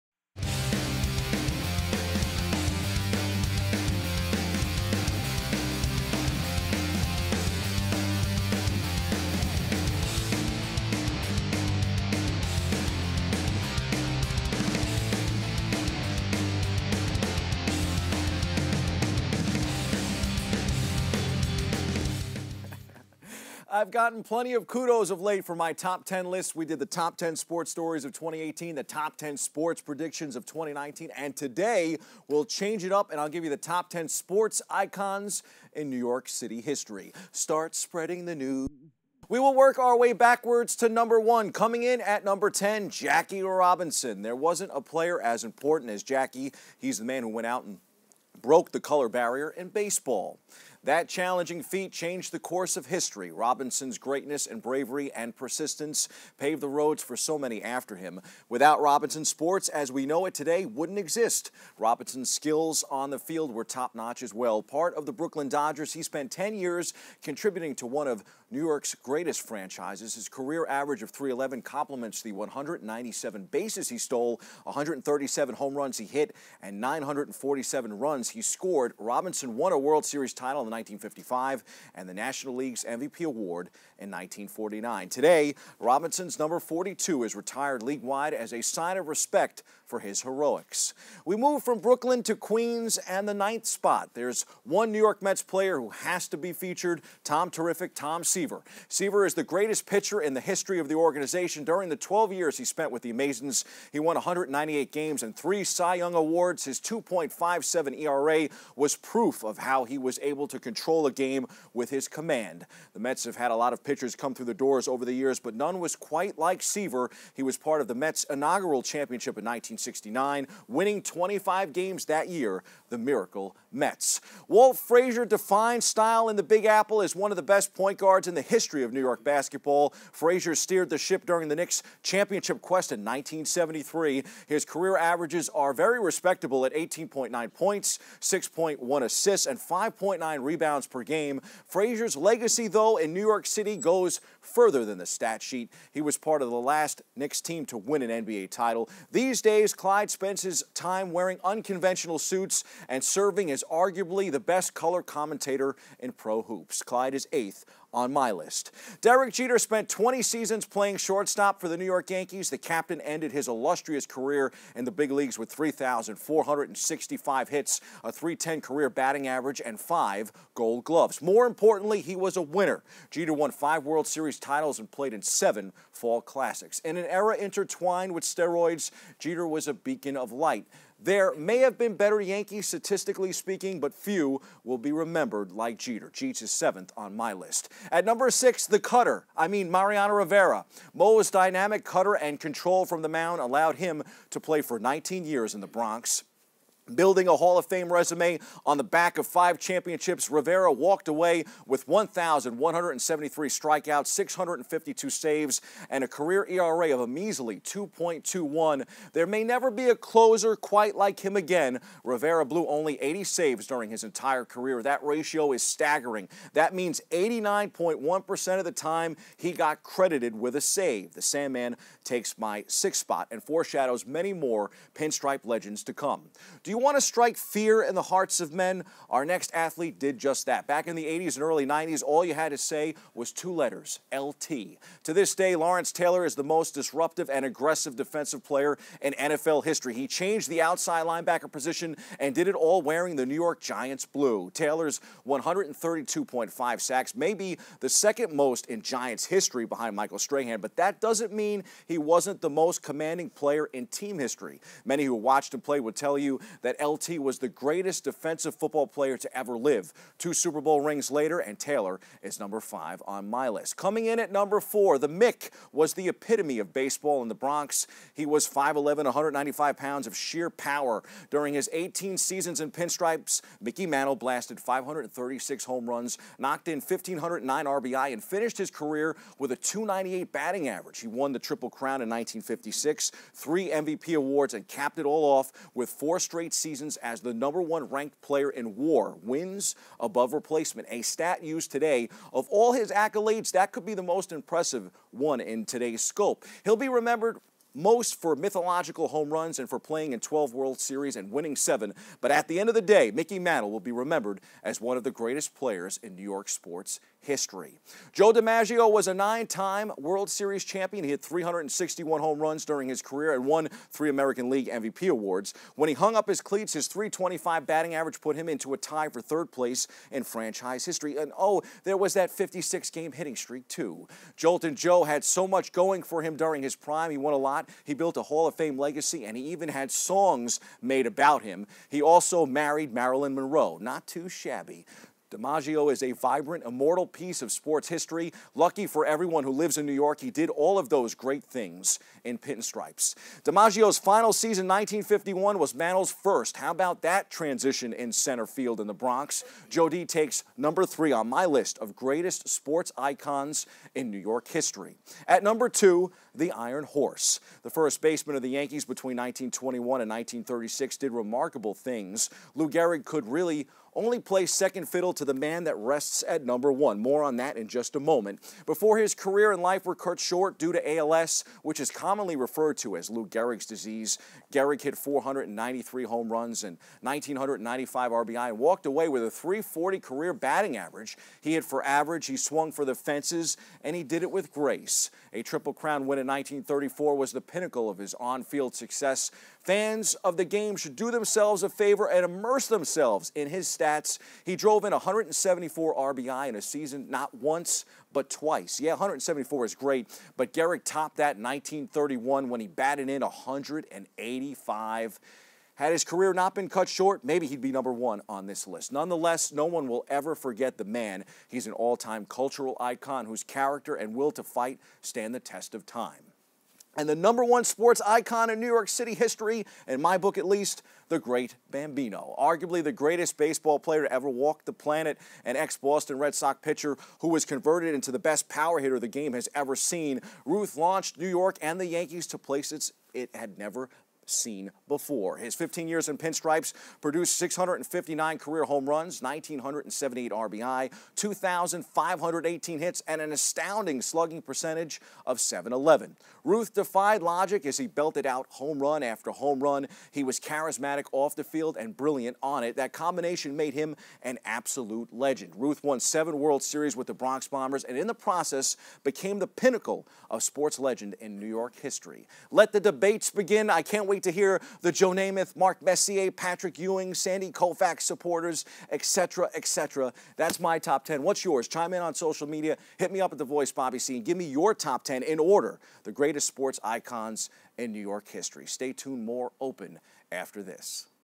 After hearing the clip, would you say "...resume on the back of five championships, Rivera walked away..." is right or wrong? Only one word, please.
right.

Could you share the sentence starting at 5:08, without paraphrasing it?
Joe DiMaggio was a nine time World Series champion.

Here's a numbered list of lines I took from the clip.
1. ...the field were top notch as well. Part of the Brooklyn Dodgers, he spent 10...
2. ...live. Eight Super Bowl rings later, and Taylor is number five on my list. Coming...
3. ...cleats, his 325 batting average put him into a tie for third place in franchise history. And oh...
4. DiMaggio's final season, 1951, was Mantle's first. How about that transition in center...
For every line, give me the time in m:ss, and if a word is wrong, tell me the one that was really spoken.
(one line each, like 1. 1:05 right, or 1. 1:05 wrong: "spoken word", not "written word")
1. 1:03 right
2. 4:19 wrong: "Two", not "Eight"
3. 5:16 right
4. 5:43 right.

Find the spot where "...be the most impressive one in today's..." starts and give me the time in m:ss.
4:53.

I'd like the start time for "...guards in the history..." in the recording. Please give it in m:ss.
2:07.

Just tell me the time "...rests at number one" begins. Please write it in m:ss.
6:05.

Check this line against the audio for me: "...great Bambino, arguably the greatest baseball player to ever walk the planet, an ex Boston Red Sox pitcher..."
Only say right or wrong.
right.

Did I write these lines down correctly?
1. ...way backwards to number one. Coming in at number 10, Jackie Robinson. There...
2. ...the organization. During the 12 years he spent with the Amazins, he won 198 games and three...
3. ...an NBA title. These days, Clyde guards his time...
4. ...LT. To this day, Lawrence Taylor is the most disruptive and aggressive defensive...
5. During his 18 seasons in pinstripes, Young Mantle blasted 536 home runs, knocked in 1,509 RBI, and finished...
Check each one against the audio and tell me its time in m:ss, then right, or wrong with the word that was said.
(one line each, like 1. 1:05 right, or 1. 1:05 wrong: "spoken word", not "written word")
1. 0:39 right
2. 1:40 right
3. 2:28 wrong: "spends", not "guards"
4. 3:54 right
5. 4:31 wrong: "Mickey", not "Young".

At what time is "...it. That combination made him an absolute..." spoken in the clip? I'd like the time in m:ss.
7:32.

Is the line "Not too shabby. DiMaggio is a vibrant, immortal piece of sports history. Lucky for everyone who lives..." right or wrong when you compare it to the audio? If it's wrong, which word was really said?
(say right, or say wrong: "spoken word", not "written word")
right.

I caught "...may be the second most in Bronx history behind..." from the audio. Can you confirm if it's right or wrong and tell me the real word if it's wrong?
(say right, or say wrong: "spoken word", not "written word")
wrong: "Giants", not "Bronx".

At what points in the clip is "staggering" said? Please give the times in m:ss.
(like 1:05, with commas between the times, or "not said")
3:35.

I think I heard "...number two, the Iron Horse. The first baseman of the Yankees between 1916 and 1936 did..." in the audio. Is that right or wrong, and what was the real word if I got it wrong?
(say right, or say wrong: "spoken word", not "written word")
wrong: "1921", not "1916".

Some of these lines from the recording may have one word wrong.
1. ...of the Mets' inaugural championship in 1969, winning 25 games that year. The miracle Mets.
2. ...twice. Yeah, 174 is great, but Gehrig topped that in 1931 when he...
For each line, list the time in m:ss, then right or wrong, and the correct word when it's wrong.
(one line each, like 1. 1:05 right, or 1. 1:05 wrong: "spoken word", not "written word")
1. 1:57 right
2. 6:38 right.